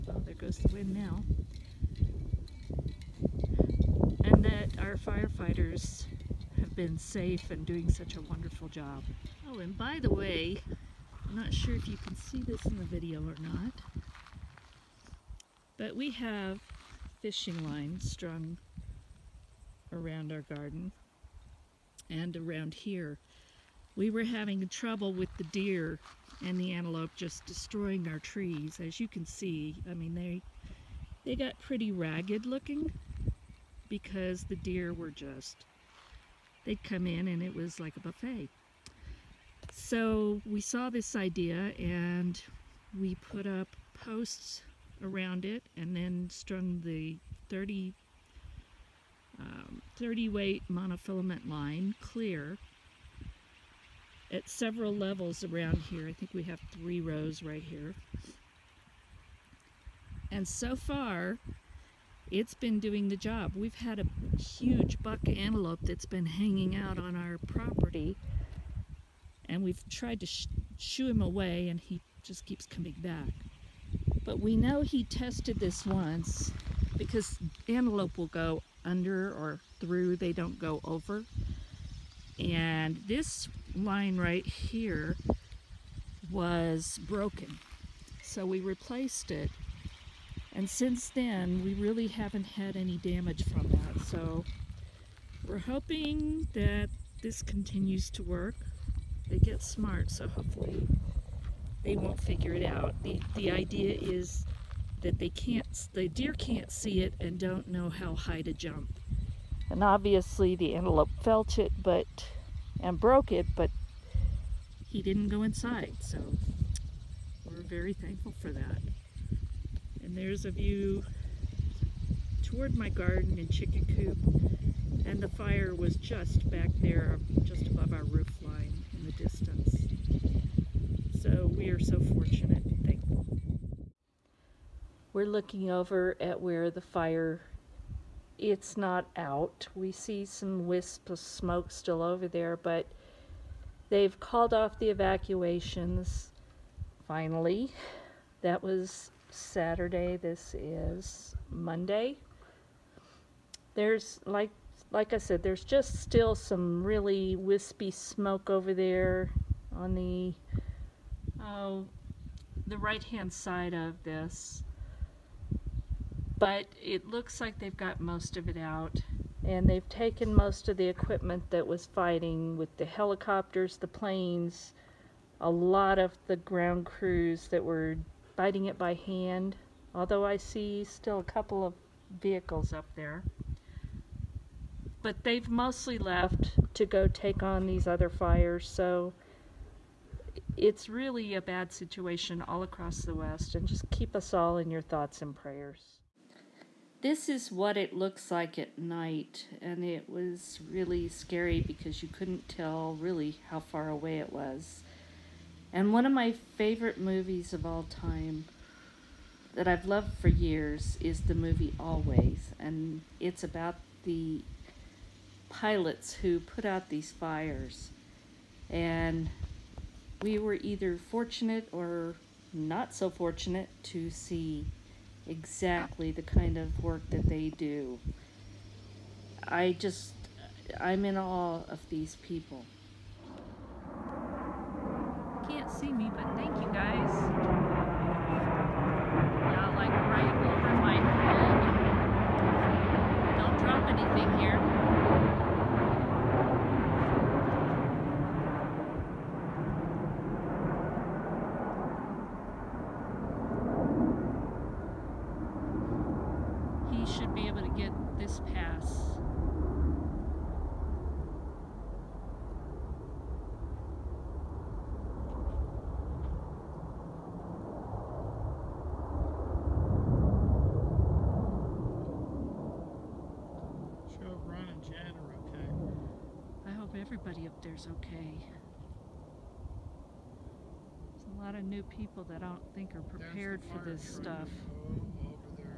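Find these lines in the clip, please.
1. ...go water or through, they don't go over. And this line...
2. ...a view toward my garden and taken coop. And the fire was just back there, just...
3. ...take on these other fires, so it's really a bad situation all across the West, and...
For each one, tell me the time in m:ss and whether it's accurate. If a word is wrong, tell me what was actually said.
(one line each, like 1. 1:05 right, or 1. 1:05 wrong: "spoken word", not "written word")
1. 1:18 wrong: "under", not "water"
2. 2:00 wrong: "chicken", not "taken"
3. 3:07 right.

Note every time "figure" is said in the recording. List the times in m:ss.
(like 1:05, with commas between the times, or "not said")
1:42.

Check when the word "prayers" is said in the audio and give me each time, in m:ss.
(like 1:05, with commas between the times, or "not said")
3:15.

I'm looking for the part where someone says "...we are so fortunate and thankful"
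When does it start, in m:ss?
2:11.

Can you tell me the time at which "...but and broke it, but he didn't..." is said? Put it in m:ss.
1:51.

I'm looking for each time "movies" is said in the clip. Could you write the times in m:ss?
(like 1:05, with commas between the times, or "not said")
3:26, 3:31.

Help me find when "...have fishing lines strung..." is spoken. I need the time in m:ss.
0:16.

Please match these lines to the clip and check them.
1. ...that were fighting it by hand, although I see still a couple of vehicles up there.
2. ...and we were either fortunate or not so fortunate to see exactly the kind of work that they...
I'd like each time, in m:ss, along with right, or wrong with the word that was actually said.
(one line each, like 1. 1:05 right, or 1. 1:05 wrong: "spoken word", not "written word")
1. 2:57 right
2. 3:38 right.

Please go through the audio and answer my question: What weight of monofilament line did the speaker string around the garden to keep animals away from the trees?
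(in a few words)
30.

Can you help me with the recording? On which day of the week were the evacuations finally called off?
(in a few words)
Saturday.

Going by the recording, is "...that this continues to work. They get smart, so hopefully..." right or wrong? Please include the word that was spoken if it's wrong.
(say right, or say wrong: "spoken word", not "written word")
right.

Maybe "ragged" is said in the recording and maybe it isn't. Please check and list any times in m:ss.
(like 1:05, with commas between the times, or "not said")
0:31.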